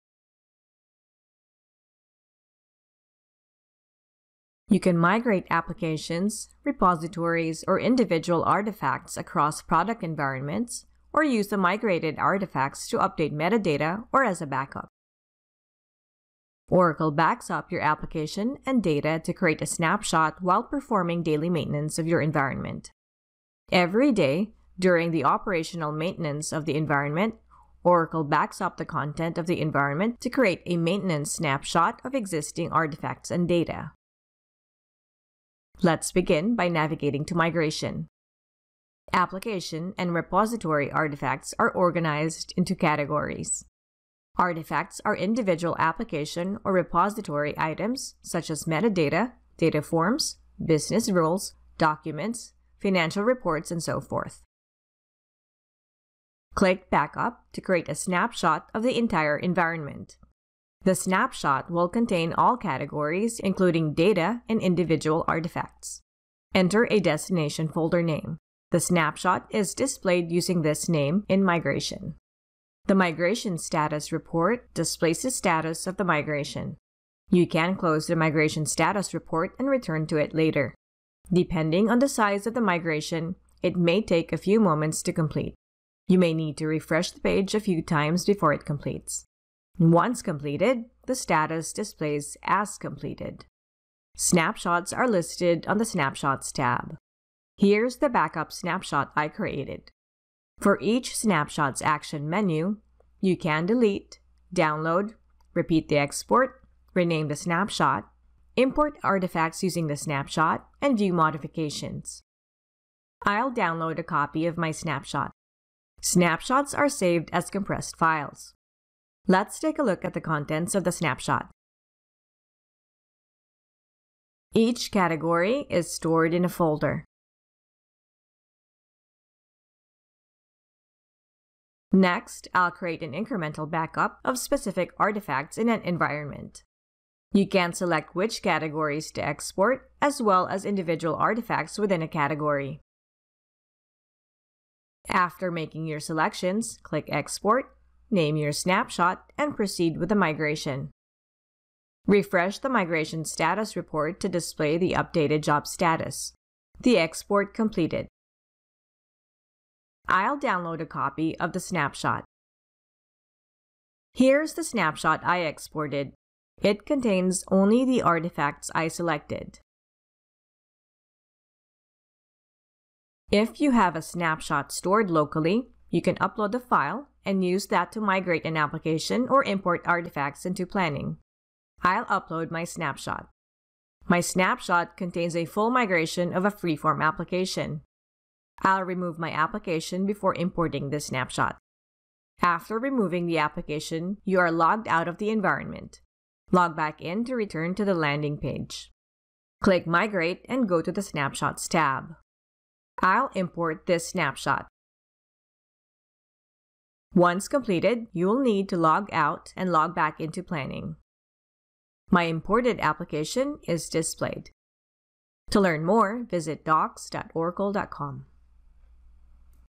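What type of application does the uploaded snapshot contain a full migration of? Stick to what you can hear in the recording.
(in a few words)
freeform application.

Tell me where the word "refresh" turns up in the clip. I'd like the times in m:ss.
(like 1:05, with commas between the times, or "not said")
1:26, 2:32.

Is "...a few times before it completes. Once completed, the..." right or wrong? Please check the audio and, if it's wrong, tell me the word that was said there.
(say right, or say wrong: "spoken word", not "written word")
right.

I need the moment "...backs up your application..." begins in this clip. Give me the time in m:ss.
0:17.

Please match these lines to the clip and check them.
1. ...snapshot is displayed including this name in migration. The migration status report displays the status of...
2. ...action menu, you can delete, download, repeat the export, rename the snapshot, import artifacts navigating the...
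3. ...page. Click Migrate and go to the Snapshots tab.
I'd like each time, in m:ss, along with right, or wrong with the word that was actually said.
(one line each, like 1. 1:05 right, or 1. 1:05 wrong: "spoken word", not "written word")
1. 1:08 wrong: "using", not "including"
2. 1:41 wrong: "using", not "navigating"
3. 3:18 right.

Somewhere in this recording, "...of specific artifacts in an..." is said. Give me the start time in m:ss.
2:14.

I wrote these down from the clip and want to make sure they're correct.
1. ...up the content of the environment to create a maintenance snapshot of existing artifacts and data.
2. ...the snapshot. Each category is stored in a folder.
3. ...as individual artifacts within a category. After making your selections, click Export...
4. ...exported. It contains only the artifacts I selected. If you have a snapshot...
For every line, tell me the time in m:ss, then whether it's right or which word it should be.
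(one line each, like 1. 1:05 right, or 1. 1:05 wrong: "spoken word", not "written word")
1. 0:28 right
2. 2:00 right
3. 2:20 right
4. 2:45 right.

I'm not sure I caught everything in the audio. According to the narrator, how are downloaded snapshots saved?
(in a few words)
compressed files.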